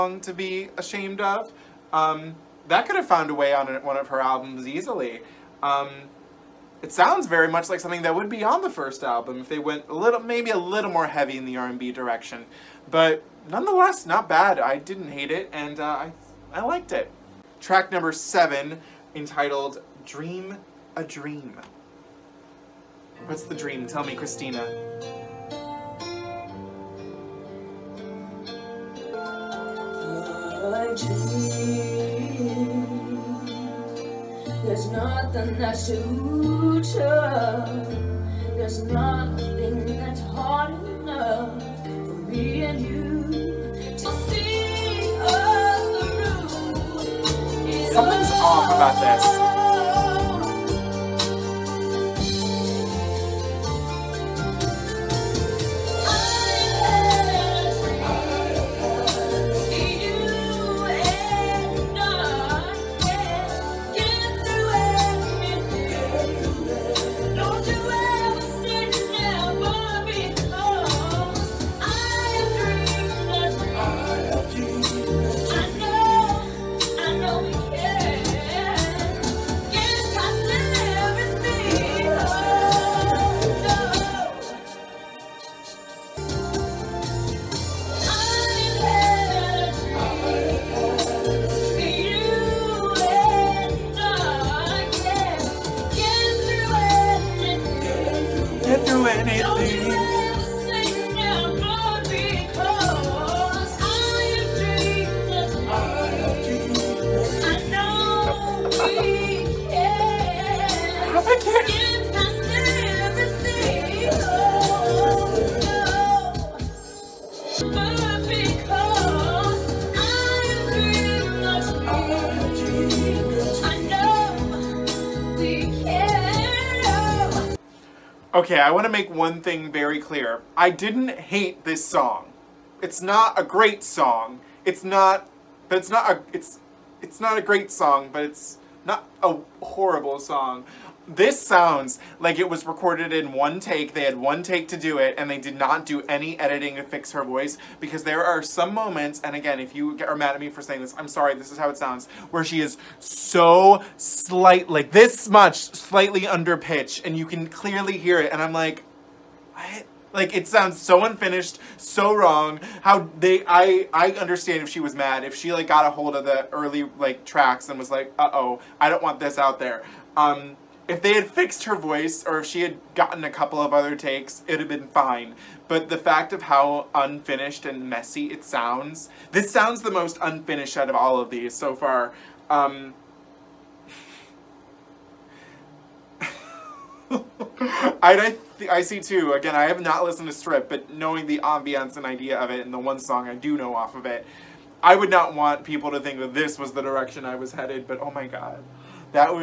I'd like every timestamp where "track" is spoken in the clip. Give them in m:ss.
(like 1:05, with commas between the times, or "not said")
0:17, 2:47.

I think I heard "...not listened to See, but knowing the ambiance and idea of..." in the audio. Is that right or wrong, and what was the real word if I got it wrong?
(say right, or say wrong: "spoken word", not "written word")
wrong: "Strip", not "See".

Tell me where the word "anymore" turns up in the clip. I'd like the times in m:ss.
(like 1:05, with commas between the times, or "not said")
not said.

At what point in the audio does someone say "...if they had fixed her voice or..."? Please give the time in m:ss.
2:50.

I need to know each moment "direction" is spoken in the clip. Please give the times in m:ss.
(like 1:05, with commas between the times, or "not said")
0:11, 3:16.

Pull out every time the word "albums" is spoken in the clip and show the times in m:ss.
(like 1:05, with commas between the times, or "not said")
0:04, 0:09.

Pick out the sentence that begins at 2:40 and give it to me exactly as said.
Like it sounds so unfinished, so wrong.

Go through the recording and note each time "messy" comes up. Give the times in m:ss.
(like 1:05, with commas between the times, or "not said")
2:57.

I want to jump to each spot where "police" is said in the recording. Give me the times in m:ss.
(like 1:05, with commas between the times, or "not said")
not said.